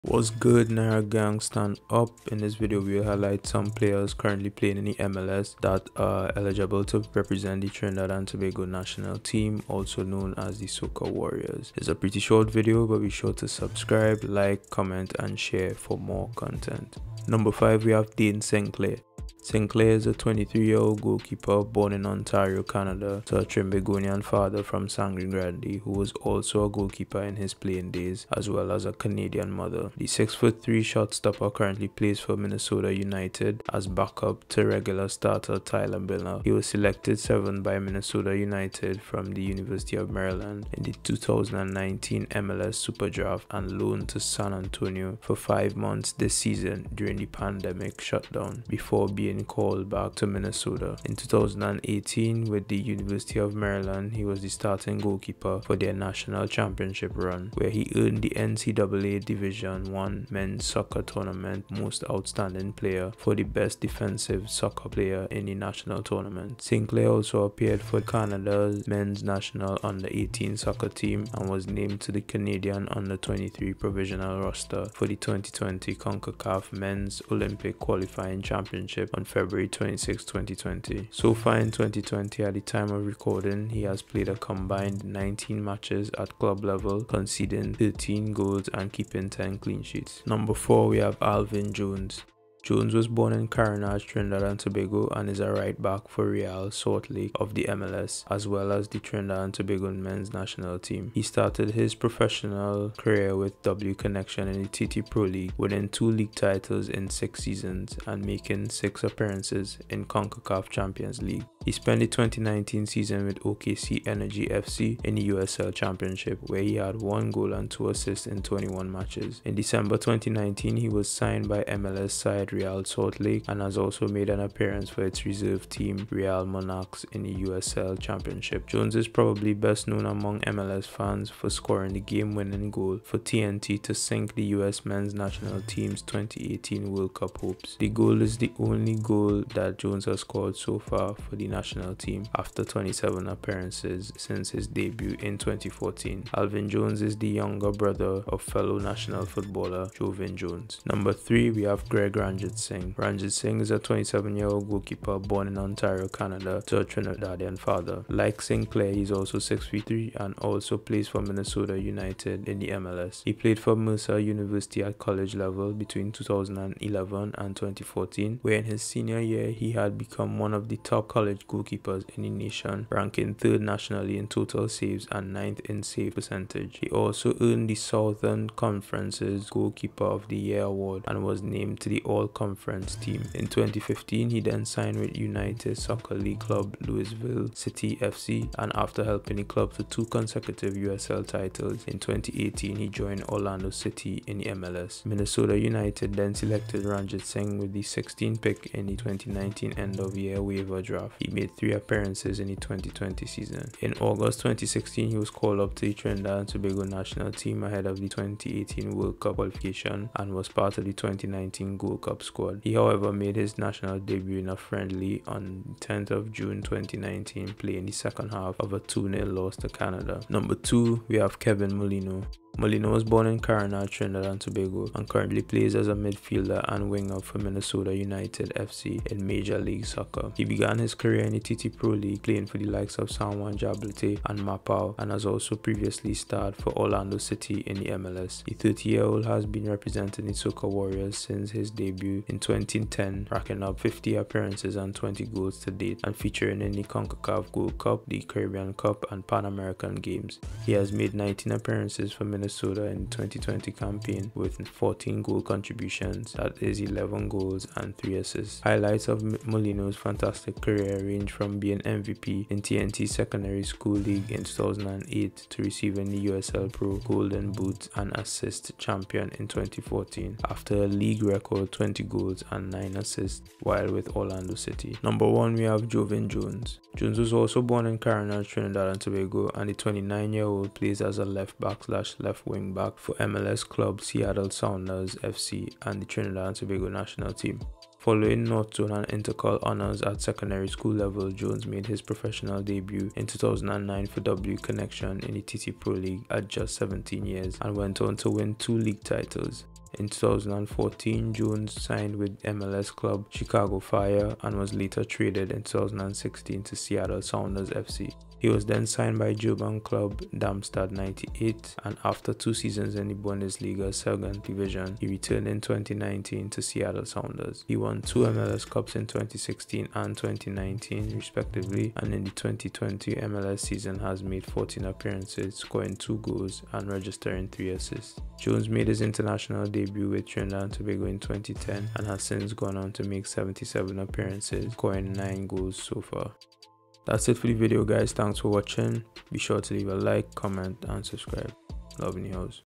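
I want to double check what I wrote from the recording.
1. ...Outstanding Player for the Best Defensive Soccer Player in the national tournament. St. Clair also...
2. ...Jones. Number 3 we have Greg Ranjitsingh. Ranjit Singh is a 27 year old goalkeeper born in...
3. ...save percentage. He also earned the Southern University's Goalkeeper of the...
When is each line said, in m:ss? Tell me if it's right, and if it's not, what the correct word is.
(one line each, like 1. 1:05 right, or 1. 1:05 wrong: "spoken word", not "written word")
1. 1:02 right
2. 2:30 right
3. 2:55 wrong: "Conference", not "University".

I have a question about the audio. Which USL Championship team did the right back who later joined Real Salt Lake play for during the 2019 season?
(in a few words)
OKC Energy FC.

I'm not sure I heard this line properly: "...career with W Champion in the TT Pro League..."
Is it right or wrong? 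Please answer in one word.
wrong.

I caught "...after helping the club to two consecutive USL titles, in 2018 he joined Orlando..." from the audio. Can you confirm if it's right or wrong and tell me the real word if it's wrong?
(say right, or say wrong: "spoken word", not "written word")
right.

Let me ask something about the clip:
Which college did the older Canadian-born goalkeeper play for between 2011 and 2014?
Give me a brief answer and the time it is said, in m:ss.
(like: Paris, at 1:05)
Mercer University, at 2:43.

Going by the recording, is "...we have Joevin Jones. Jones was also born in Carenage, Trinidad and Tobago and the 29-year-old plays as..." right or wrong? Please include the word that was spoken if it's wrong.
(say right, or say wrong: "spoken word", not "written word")
right.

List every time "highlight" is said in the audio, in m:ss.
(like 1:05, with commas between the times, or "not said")
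0:03, 4:18.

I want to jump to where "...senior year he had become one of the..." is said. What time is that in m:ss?
2:48.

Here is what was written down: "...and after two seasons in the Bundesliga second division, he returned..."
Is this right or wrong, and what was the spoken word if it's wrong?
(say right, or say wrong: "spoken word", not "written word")
right.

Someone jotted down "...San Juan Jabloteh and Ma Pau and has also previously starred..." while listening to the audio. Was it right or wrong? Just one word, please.
right.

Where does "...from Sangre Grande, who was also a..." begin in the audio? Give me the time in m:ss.
0:24.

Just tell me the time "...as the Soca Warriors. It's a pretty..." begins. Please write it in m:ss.
0:10.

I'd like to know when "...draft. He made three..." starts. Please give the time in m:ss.
3:20.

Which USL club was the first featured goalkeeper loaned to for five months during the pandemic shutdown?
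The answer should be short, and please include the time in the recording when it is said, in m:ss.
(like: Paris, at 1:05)
San Antonio, at 0:44.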